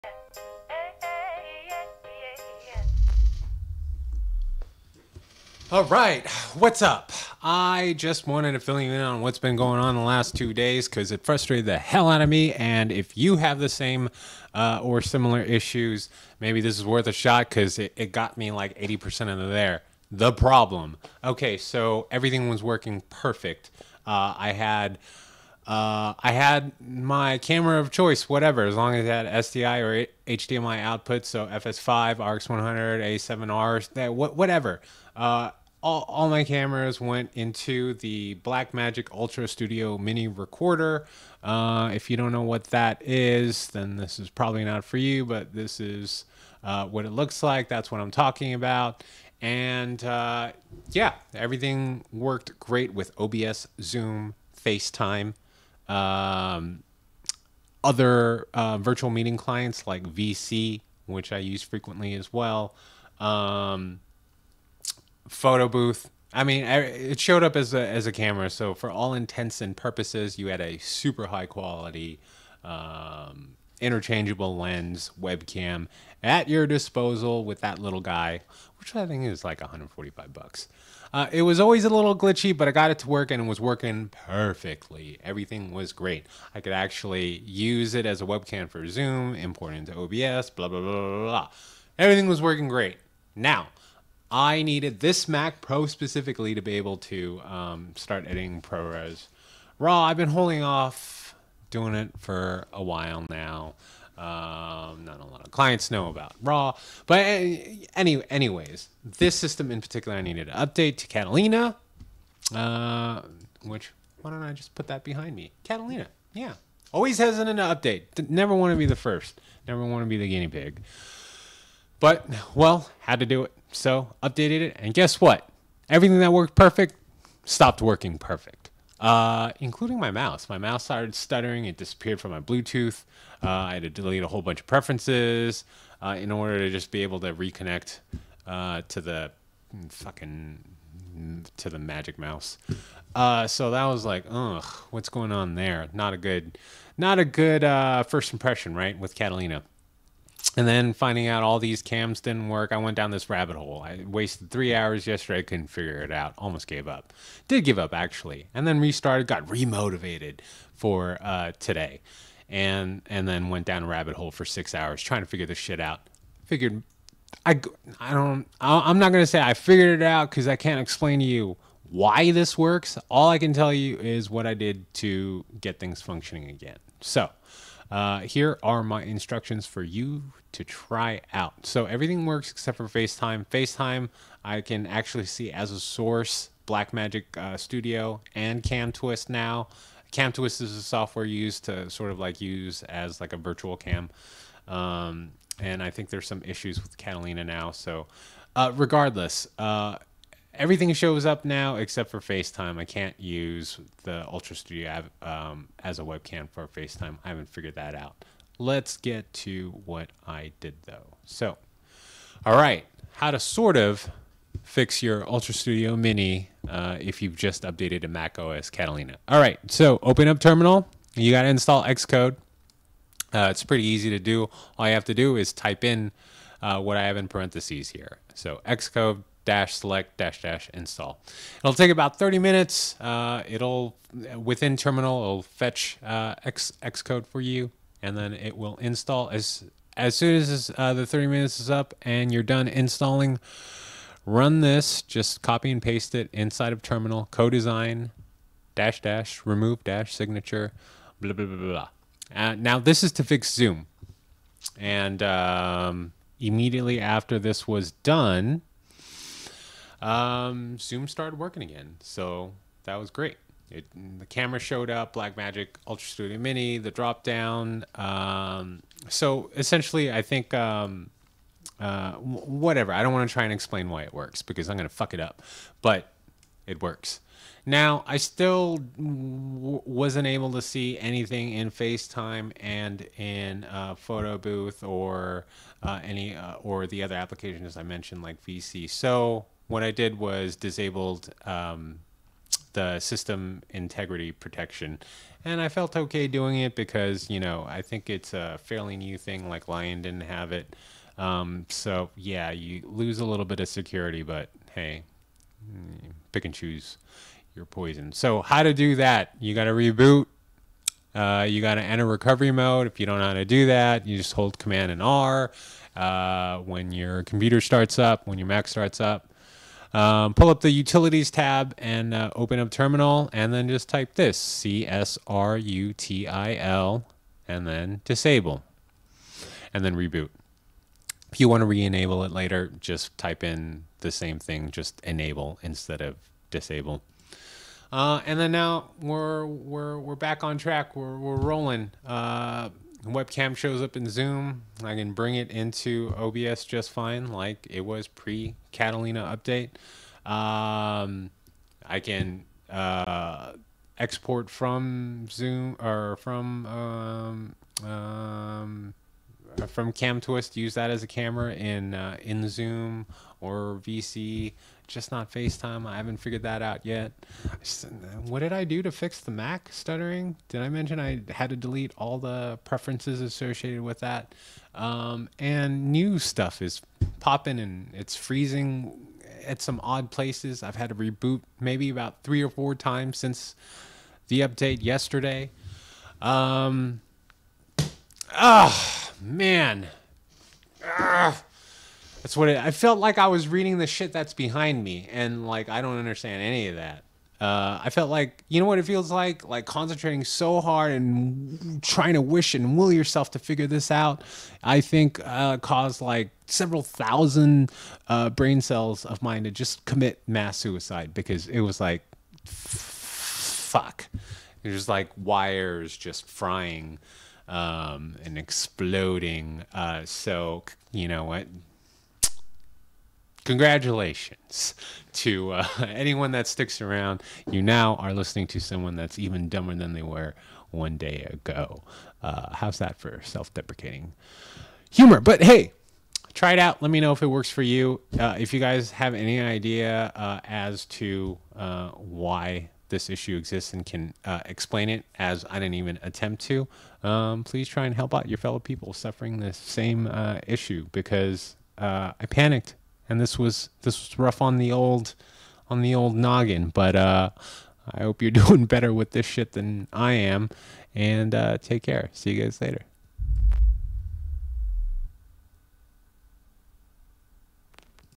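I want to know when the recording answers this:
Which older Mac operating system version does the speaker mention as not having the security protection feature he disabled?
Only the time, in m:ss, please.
4:59.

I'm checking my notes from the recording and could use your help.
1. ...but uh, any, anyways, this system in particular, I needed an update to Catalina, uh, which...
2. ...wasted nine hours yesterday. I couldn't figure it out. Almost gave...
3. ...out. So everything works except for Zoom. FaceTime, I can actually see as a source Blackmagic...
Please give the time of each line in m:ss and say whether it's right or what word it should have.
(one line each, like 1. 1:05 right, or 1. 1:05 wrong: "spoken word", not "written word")
1. 1:47 right
2. 2:34 wrong: "three", not "nine"
3. 3:01 wrong: "FaceTime", not "Zoom".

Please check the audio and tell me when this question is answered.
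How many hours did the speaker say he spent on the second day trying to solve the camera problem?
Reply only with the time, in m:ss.
2:44.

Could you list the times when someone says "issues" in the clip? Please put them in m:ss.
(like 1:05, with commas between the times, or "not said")
0:15, 3:16, 7:23, 7:30.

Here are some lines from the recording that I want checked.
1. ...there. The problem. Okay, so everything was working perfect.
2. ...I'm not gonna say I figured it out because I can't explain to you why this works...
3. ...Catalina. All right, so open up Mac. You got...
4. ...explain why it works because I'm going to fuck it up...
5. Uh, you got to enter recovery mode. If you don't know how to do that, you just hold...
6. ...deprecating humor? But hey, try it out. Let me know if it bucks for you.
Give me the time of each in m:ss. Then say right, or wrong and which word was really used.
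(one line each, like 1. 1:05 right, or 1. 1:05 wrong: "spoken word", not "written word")
1. 0:19 right
2. 2:48 right
3. 3:38 wrong: "Terminal", not "Mac"
4. 4:33 right
5. 5:11 right
6. 7:13 wrong: "works", not "bucks".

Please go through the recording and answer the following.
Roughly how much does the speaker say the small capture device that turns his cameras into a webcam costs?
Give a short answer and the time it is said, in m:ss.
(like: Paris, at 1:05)
$145, at 1:19.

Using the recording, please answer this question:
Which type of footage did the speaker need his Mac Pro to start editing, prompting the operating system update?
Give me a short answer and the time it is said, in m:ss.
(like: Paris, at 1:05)
ProRes RAW, at 1:38.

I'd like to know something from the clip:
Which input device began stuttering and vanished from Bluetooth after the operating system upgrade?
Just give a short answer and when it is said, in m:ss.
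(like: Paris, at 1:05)
Magic Mouse, at 2:21.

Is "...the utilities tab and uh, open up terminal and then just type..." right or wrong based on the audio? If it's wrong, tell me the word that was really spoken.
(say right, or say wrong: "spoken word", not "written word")
right.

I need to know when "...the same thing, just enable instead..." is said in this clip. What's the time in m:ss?
5:33.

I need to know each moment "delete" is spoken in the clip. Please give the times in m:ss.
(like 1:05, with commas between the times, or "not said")
2:13, 6:11.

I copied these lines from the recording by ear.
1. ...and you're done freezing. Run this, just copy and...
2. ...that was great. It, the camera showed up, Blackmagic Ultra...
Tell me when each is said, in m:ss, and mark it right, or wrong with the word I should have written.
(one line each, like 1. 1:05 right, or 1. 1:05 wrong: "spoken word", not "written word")
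1. 4:02 wrong: "installing", not "freezing"
2. 4:22 right.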